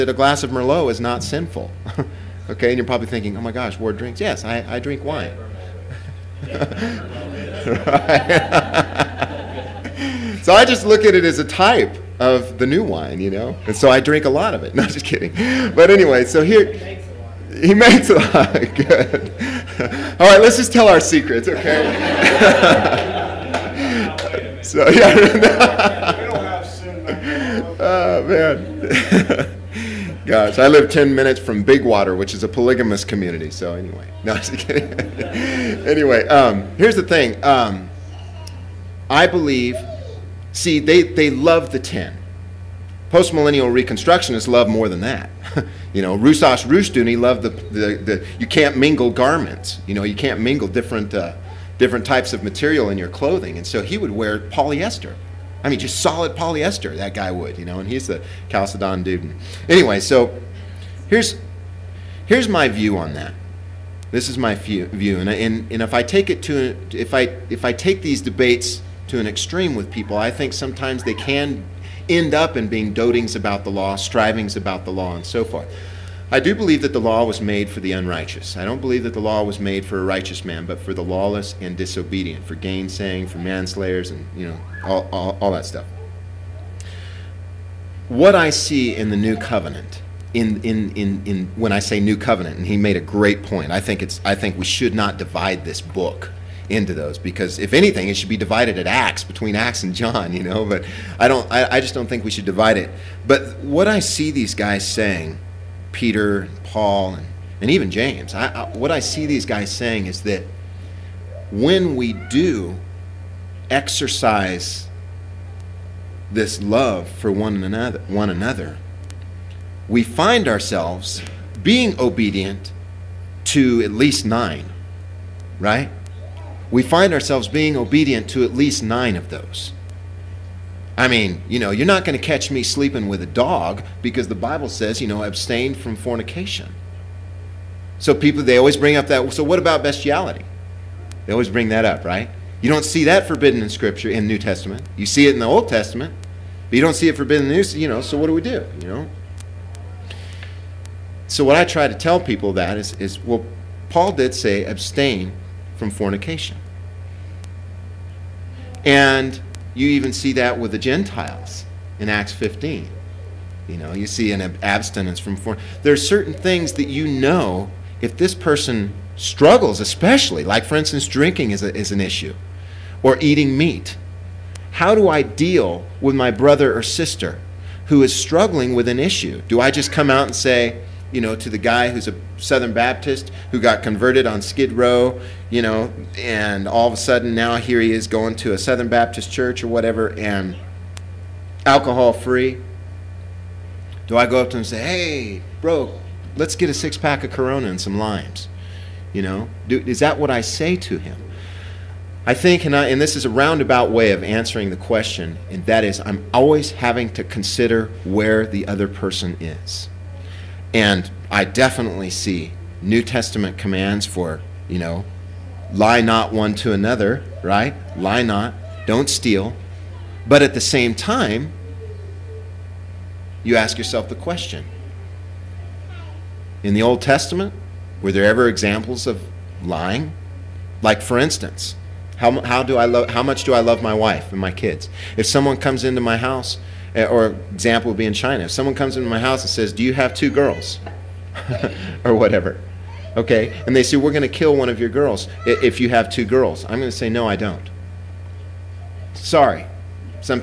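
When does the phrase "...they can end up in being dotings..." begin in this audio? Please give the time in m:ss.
1:11.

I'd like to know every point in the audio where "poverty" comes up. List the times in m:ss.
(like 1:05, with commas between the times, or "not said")
not said.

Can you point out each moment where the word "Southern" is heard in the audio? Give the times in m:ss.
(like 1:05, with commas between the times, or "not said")
3:02, 3:08.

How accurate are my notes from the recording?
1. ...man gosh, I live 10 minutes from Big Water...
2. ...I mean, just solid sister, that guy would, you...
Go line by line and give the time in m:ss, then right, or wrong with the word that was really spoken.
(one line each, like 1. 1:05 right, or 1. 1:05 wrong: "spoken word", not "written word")
1. 0:28 right
2. 0:55 wrong: "polyester", not "sister".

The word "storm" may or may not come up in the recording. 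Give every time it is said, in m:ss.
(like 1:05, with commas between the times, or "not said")
not said.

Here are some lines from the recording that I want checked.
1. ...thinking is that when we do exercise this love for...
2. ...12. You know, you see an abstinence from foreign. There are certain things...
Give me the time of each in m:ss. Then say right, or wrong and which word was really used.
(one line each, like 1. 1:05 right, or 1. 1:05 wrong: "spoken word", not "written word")
1. 1:49 wrong: "saying", not "thinking"
2. 2:42 wrong: "15", not "12".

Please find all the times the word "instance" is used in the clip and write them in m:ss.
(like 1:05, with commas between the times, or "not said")
2:50, 3:51.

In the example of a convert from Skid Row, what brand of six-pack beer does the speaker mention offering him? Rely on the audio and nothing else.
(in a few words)
Corona.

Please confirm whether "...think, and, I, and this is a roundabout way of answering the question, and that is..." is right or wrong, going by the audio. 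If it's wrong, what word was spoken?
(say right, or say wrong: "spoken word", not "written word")
right.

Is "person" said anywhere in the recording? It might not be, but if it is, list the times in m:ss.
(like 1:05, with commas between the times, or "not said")
2:48, 3:28.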